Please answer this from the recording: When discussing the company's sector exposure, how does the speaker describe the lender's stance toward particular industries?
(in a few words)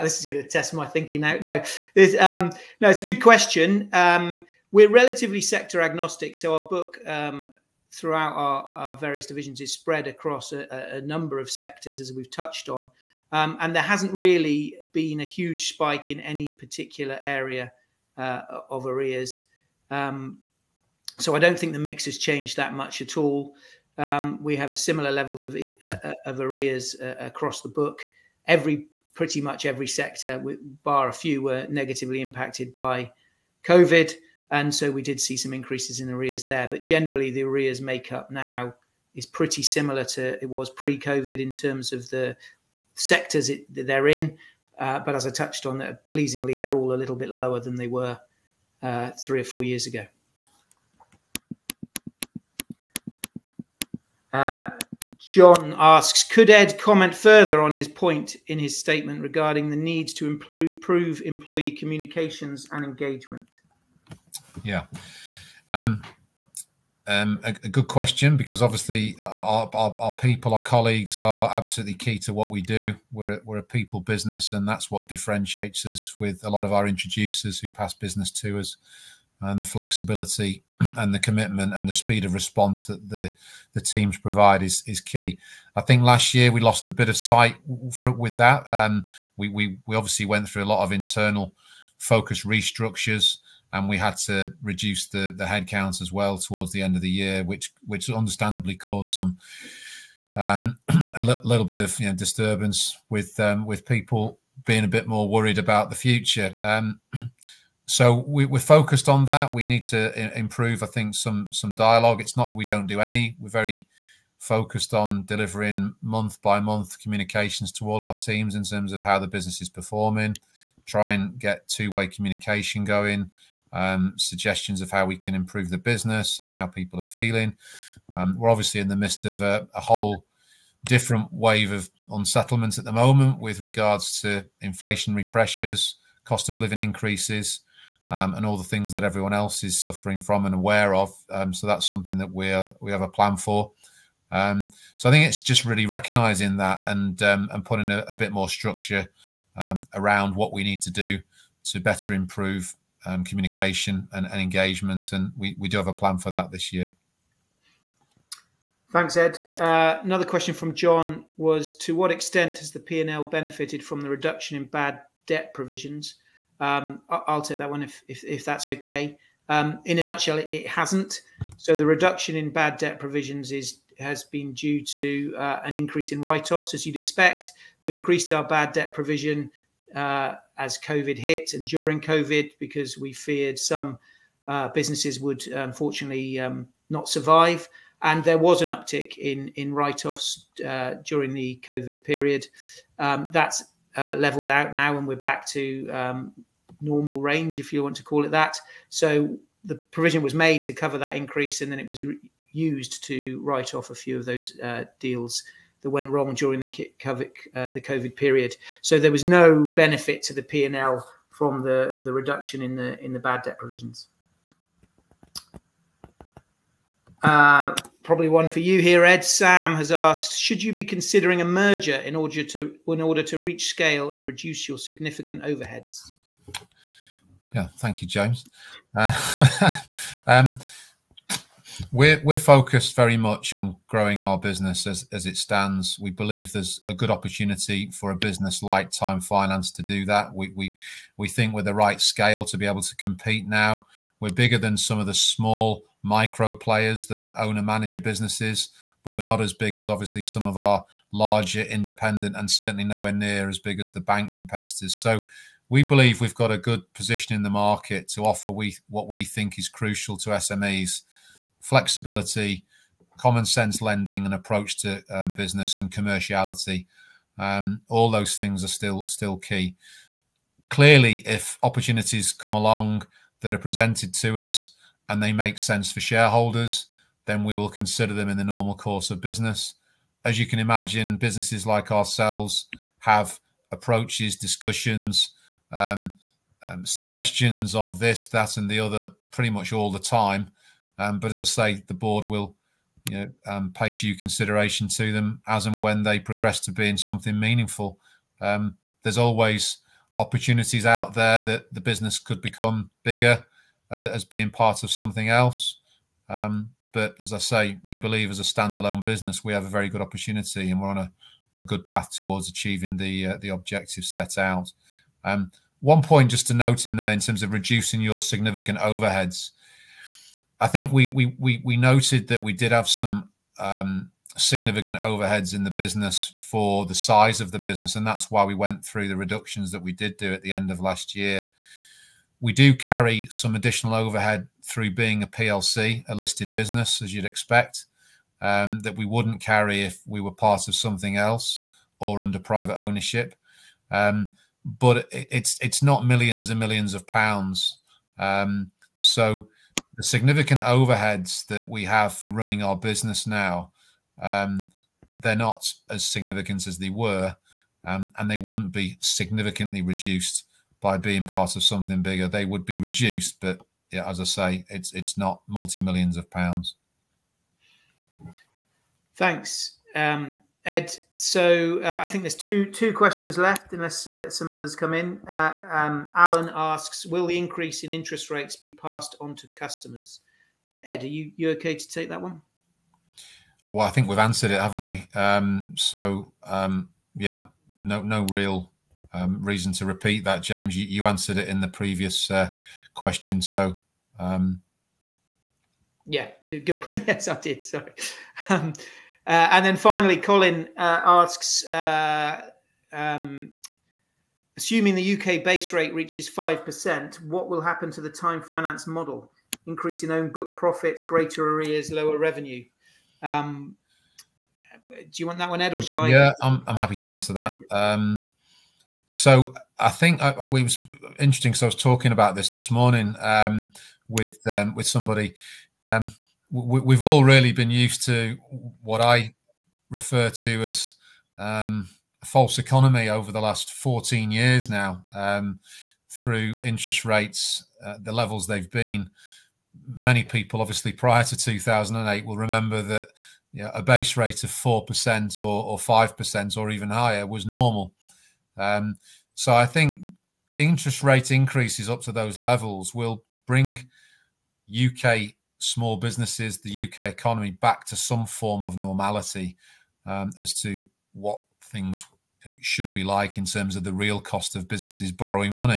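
Sector agnostic.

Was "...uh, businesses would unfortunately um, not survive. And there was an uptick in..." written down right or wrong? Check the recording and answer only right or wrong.
right.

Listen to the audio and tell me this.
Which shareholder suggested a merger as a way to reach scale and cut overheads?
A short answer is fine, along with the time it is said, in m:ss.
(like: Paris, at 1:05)
Sam, at 3:39.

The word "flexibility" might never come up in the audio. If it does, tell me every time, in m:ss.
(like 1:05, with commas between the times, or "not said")
1:19, 4:21.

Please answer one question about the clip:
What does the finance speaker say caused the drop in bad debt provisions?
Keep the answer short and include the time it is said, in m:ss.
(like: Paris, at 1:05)
An increase in write-offs, at 2:55.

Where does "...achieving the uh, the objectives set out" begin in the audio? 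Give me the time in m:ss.
5:12.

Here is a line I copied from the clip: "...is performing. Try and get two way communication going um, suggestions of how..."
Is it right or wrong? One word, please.
right.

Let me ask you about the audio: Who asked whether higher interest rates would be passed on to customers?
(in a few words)
Alan.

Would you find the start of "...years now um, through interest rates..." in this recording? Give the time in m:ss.
7:14.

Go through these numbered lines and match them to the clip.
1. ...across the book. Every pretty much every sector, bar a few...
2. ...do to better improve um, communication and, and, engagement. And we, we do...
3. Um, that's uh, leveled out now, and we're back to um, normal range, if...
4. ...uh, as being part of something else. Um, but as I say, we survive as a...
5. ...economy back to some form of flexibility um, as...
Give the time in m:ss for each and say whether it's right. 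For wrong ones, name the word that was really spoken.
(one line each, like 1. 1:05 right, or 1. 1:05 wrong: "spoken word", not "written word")
1. 0:27 right
2. 2:30 right
3. 3:12 right
4. 5:03 wrong: "believe", not "survive"
5. 7:37 wrong: "normality", not "flexibility".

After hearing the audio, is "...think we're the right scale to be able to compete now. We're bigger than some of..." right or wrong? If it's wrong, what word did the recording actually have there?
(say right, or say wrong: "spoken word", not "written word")
right.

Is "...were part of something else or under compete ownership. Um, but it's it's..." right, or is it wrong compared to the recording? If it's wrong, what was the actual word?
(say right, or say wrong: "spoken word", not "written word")
wrong: "private", not "compete".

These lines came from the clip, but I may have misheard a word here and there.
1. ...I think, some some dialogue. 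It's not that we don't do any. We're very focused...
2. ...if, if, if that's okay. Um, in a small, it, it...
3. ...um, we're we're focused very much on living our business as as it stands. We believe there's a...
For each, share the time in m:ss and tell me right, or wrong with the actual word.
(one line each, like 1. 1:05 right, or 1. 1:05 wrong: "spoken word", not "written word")
1. 1:50 right
2. 2:47 wrong: "nutshell", not "small"
3. 3:50 wrong: "growing", not "living".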